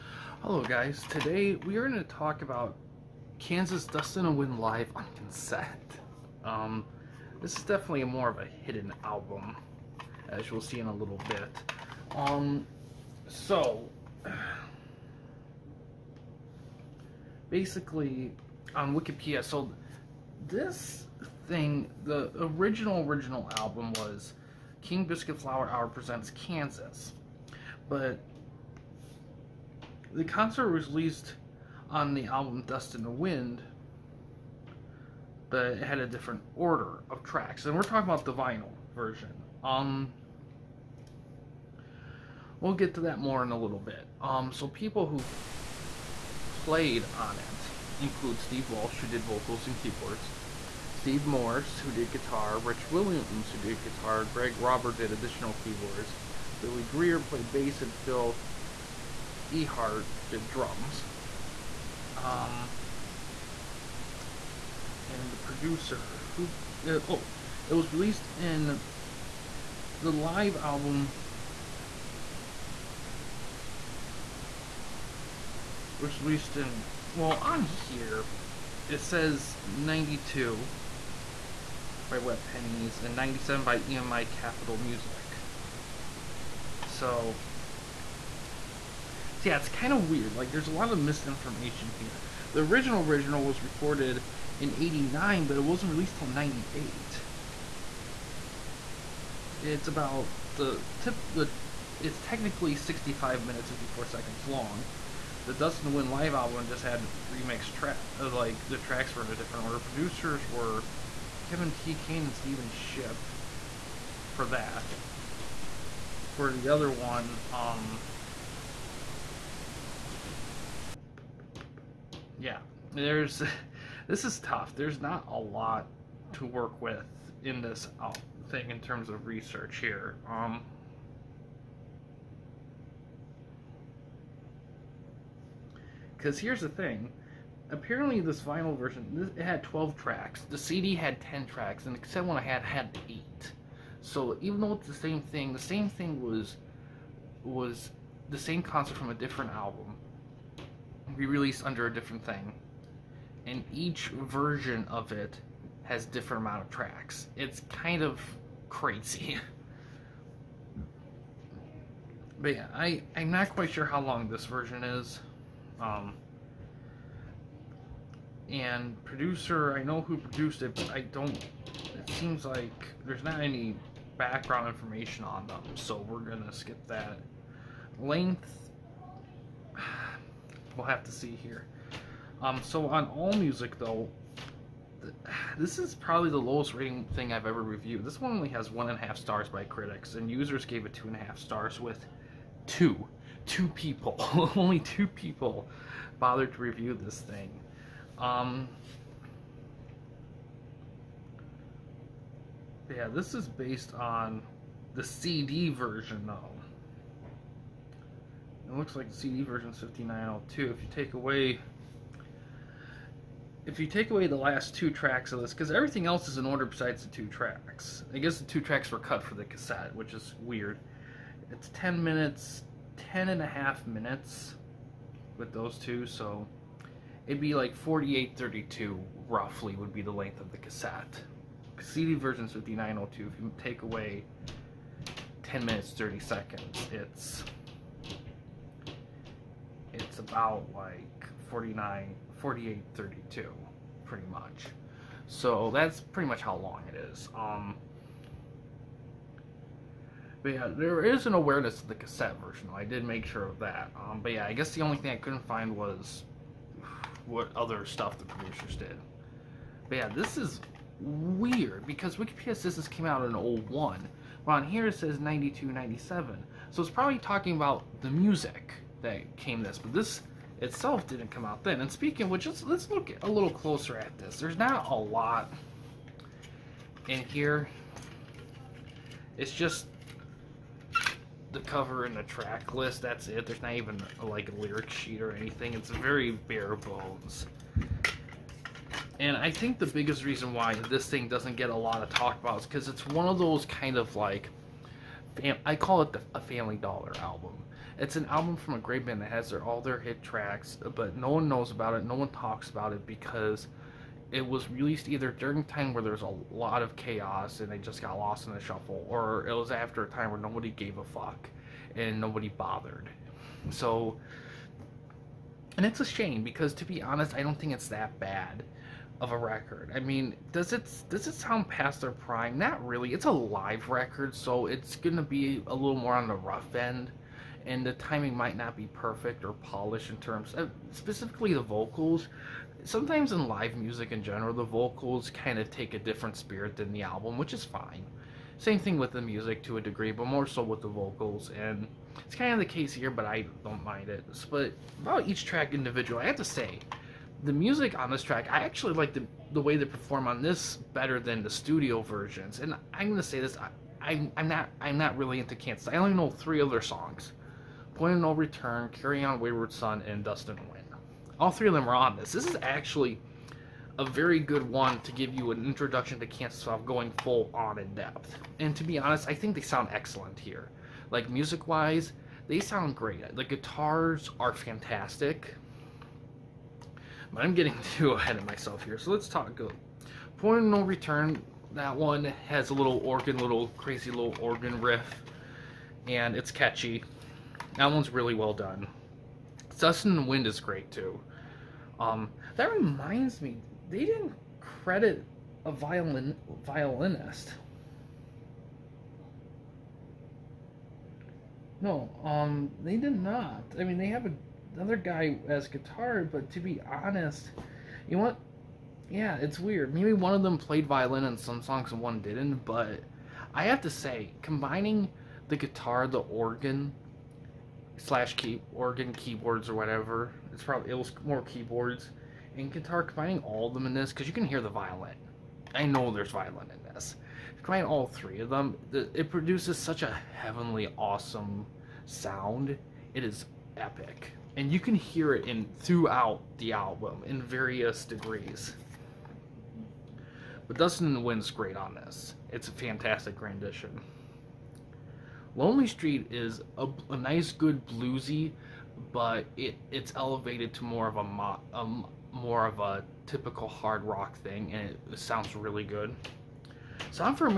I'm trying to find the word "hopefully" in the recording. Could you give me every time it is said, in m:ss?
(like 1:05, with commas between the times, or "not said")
not said.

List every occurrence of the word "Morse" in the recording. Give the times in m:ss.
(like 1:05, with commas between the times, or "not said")
0:51.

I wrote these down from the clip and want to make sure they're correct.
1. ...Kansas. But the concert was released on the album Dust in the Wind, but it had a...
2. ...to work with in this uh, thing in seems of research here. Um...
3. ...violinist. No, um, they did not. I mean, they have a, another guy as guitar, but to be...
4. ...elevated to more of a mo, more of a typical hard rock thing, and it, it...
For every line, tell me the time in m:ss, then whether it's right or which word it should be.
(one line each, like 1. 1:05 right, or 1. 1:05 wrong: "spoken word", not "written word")
1. 0:26 right
2. 2:06 wrong: "terms", not "seems"
3. 6:36 right
4. 7:30 right.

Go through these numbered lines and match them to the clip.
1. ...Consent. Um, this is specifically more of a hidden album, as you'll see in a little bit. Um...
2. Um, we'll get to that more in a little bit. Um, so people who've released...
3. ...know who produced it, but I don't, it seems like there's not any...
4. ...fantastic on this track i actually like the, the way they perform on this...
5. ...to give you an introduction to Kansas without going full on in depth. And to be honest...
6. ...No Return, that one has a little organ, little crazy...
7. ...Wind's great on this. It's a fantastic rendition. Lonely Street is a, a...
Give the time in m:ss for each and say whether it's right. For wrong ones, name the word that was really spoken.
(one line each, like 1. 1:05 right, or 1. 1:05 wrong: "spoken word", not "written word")
1. 0:05 wrong: "definitely", not "specifically"
2. 0:39 wrong: "played", not "released"
3. 2:49 right
4. 5:47 wrong: "music", not "fantastic"
5. 6:05 right
6. 6:20 right
7. 7:21 right.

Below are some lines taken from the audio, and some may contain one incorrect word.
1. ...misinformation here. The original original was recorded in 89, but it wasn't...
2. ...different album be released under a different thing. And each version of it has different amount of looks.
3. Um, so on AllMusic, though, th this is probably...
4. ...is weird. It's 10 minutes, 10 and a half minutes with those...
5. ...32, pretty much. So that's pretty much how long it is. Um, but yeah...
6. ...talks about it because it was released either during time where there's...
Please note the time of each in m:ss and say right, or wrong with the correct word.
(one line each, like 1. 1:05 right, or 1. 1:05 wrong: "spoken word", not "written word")
1. 1:30 right
2. 2:29 wrong: "tracks", not "looks"
3. 3:02 right
4. 3:40 right
5. 4:02 right
6. 5:02 right.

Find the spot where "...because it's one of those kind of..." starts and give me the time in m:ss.
4:52.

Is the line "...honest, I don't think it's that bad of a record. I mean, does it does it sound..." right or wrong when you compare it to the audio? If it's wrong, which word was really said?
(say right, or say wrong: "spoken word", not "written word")
right.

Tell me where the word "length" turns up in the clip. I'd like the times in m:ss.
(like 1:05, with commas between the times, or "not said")
2:57, 3:50.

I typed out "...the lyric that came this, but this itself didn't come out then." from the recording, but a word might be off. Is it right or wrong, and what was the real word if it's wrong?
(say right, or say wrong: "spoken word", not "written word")
wrong: "music", not "lyric".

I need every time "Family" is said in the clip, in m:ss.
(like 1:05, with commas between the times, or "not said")
4:56.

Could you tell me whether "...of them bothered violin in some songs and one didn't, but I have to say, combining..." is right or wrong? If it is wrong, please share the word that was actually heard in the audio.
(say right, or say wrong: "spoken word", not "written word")
wrong: "played", not "bothered".